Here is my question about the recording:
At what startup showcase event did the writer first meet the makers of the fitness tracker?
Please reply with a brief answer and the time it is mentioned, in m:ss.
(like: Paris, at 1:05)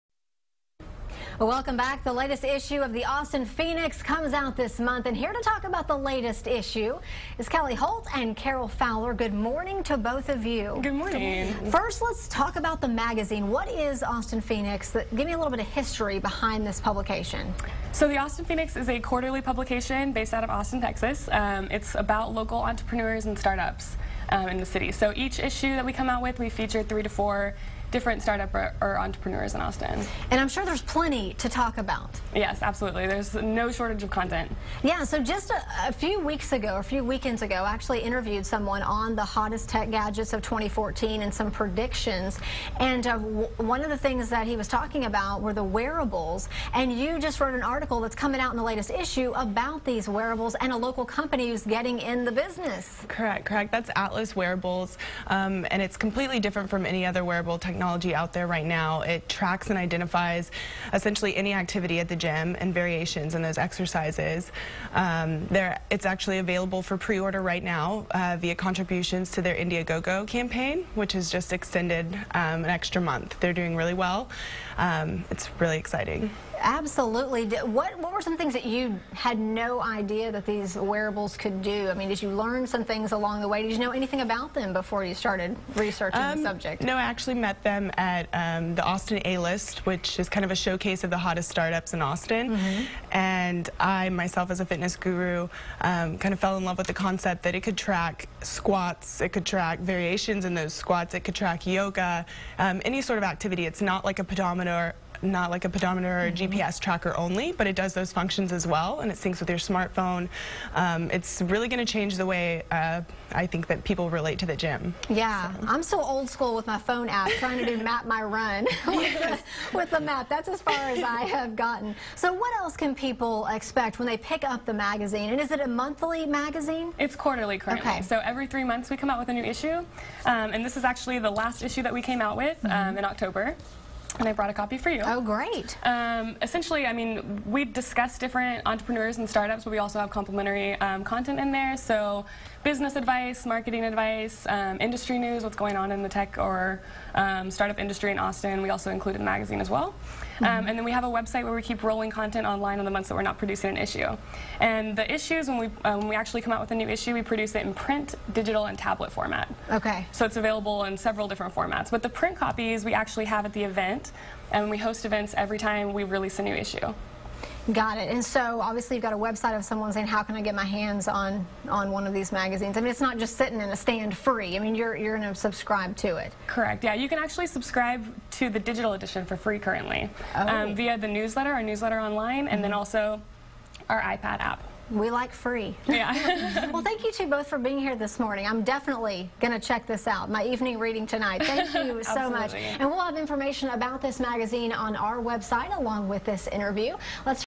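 Austin A-List, at 1:28.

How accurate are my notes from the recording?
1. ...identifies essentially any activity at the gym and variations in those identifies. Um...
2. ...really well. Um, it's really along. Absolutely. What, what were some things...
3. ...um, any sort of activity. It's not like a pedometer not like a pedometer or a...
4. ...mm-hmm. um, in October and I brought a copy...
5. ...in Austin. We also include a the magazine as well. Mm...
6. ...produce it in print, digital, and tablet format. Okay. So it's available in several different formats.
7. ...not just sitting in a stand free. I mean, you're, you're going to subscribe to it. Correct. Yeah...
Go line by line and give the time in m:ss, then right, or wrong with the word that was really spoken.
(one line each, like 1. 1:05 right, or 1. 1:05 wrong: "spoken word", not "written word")
1. 0:59 wrong: "exercises", not "identifies"
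2. 1:13 wrong: "exciting", not "along"
3. 1:42 right
4. 2:12 right
5. 2:28 right
6. 2:37 right
7. 2:52 right.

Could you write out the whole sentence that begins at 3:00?
um, via the newsletter, our newsletter online, and mm -hmm.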